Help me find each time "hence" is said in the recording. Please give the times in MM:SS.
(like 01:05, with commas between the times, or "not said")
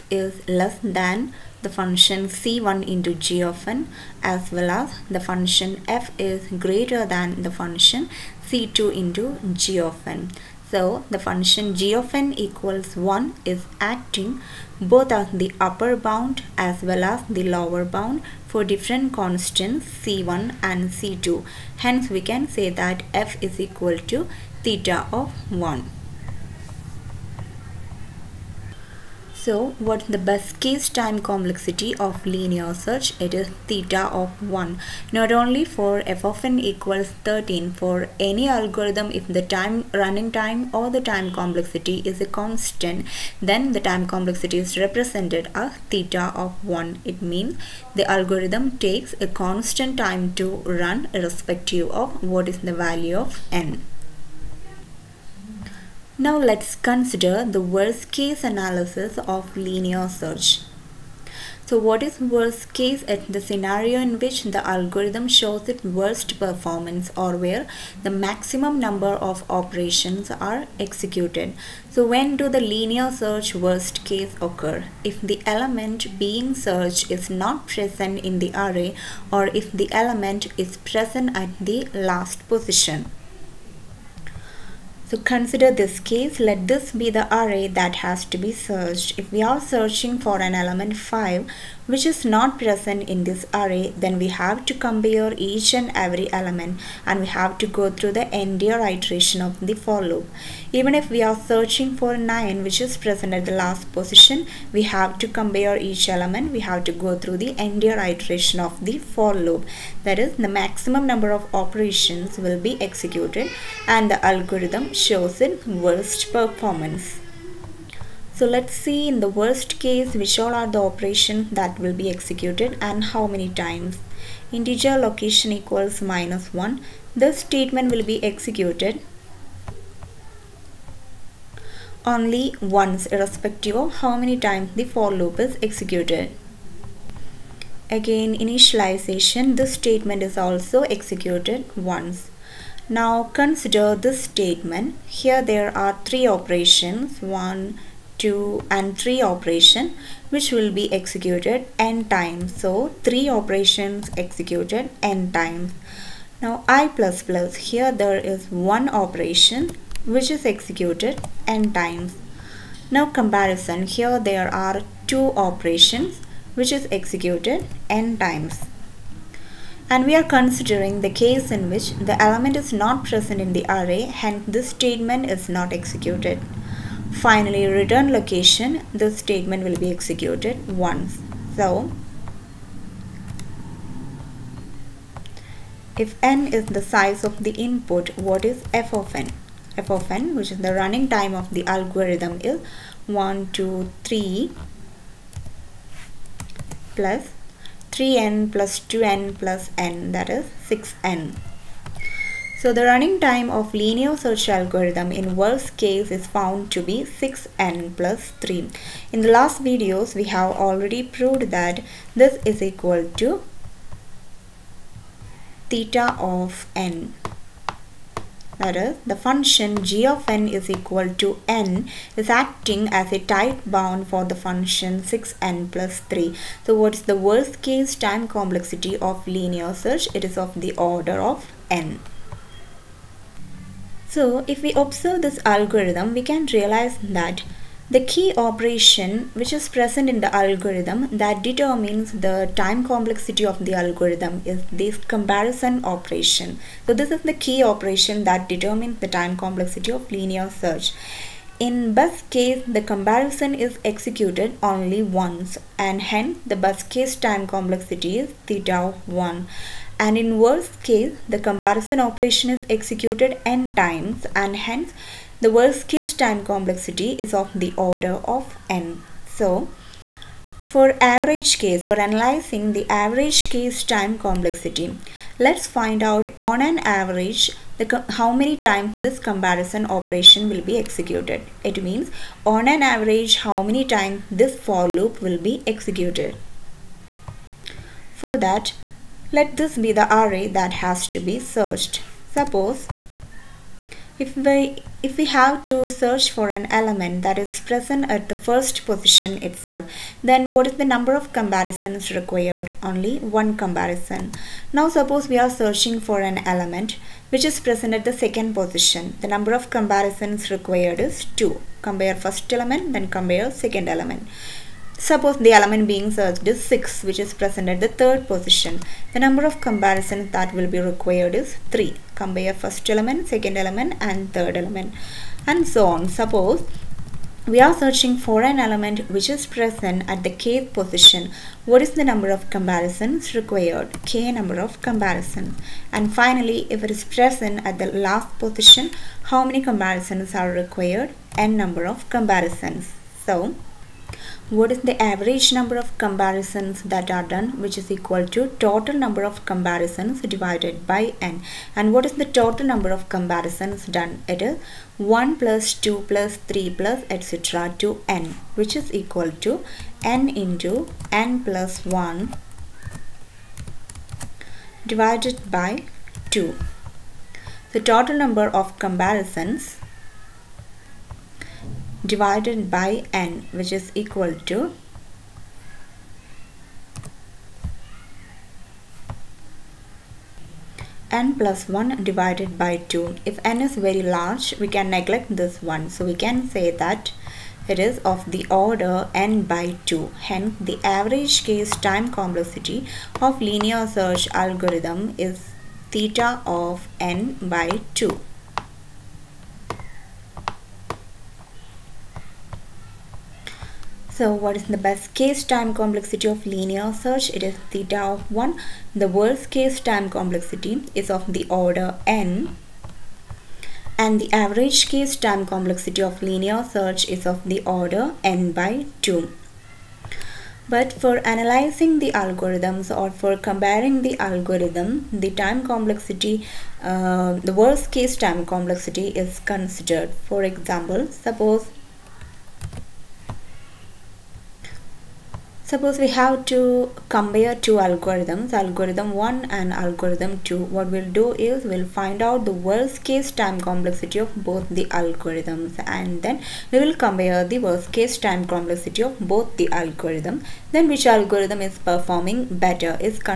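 00:21, 02:54, 04:15, 04:24, 06:30.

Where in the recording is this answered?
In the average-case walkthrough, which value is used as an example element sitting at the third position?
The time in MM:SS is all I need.
05:16.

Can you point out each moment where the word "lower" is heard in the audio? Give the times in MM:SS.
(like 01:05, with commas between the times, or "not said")
00:17.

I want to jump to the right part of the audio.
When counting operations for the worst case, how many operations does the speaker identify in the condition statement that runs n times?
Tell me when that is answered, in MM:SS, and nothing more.
02:26.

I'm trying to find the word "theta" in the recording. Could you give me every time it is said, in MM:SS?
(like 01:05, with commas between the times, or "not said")
00:24, 00:33, 00:45, 03:35, 04:18, 06:35, 06:47.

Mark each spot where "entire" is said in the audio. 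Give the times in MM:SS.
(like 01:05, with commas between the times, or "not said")
01:38, 01:47.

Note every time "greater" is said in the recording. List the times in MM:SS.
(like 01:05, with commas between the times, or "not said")
00:06.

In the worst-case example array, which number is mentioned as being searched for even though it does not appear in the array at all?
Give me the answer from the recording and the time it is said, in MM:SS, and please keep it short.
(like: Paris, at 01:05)
5, at 01:30.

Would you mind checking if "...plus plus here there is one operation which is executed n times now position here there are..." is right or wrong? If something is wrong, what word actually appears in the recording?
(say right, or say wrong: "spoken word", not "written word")
wrong: "comparison", not "position".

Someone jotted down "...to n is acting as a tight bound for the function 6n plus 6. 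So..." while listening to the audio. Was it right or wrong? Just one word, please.
wrong.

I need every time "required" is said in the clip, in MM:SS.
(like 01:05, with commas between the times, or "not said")
05:02, 05:10, 05:20, 05:33, 05:40.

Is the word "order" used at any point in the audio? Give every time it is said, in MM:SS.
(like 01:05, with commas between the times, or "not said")
03:50, 04:27, 06:28, 06:51, 06:57.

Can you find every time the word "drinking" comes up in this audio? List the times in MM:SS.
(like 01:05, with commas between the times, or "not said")
not said.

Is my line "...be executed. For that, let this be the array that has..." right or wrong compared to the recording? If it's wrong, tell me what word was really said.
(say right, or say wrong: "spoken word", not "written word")
right.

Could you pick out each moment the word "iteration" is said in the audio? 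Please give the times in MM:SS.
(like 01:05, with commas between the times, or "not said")
01:38, 01:48.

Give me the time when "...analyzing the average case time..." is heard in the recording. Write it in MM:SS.
04:31.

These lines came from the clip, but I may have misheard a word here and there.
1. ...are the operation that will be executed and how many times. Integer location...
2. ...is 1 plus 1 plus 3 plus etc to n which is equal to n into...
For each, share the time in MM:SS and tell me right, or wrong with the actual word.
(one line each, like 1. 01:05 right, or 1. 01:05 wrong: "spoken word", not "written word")
1. 02:00 right
2. 05:54 wrong: "2", not "1".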